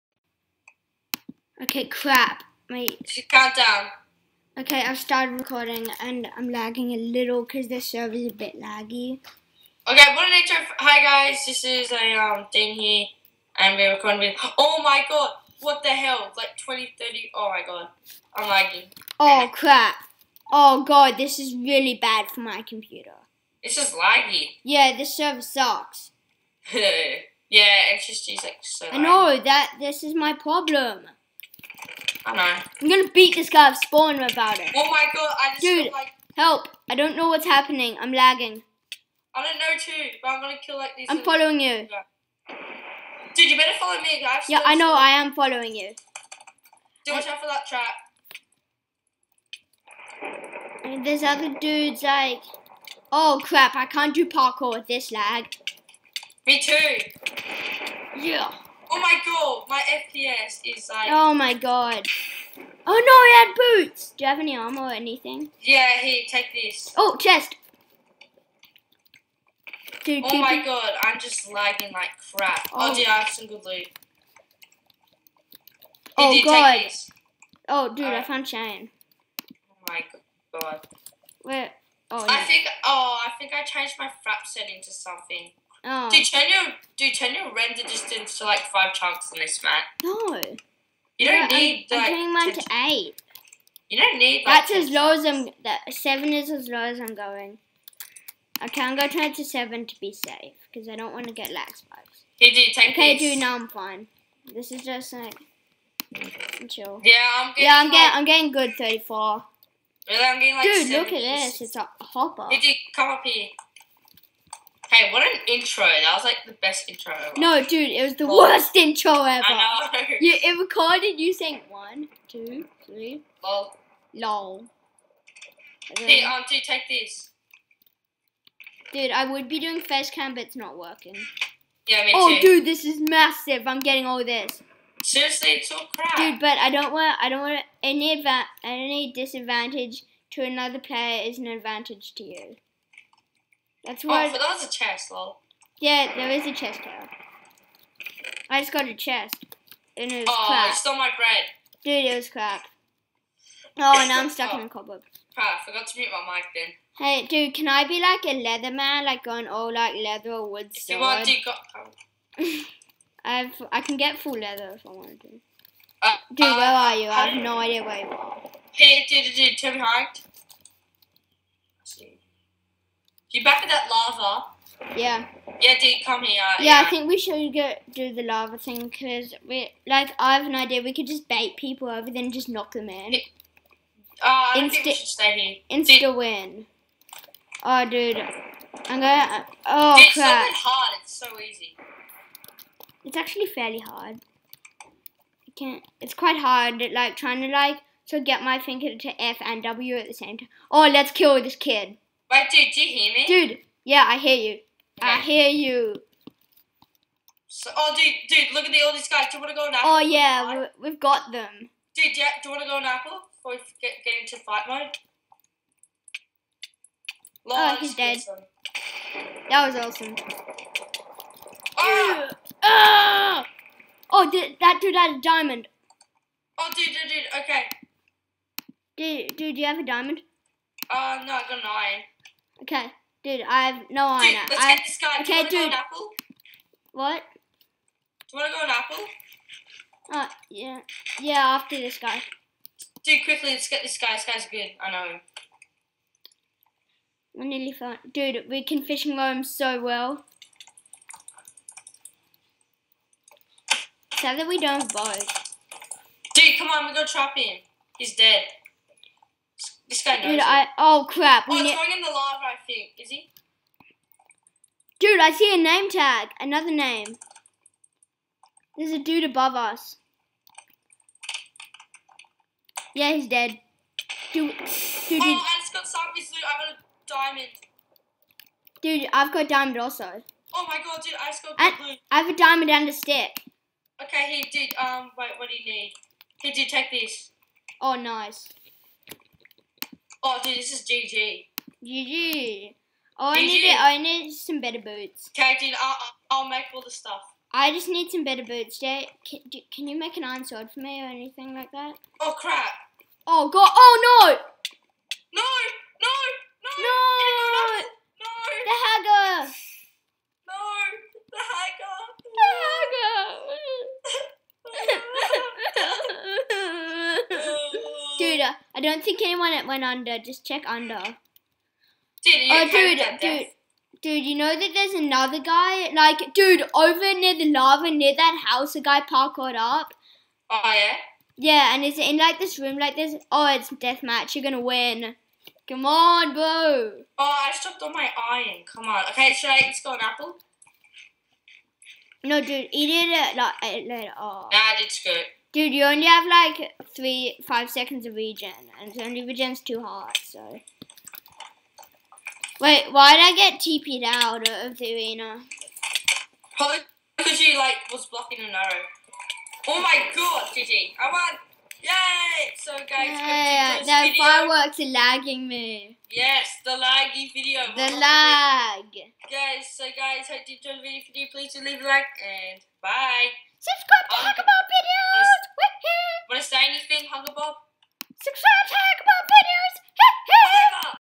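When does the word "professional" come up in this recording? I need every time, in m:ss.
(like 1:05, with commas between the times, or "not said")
not said.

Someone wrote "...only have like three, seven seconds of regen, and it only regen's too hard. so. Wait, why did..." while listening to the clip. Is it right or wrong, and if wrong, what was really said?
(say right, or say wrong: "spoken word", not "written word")
wrong: "five", not "seven".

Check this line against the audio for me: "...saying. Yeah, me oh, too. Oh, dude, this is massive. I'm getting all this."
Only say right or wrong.
wrong.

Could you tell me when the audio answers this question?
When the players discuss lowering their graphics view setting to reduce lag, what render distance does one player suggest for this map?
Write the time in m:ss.
1:28.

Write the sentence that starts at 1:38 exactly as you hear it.
Okay, I'm gonna turn it to seven to be safe, because I don't wanna get lag spikes.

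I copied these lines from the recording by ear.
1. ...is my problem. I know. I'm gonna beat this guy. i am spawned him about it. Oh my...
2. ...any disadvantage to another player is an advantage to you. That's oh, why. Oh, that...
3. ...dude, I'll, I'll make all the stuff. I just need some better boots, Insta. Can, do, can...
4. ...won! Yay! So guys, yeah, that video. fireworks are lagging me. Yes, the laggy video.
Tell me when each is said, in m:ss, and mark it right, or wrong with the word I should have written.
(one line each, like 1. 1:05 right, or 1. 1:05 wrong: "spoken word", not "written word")
1. 0:30 right
2. 2:18 right
3. 4:55 wrong: "Jay", not "Insta"
4. 6:01 right.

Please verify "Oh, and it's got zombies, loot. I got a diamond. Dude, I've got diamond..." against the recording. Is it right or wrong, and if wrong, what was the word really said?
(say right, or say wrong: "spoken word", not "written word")
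right.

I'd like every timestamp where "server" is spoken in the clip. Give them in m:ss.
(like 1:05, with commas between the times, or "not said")
0:07, 0:25.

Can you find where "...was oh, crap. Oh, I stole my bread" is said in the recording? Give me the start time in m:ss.
2:30.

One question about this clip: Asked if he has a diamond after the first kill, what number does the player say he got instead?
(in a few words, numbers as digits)
9.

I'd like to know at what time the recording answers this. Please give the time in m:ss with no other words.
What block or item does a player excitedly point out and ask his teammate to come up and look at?
1:51.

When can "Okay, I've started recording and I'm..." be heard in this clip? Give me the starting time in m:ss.
0:04.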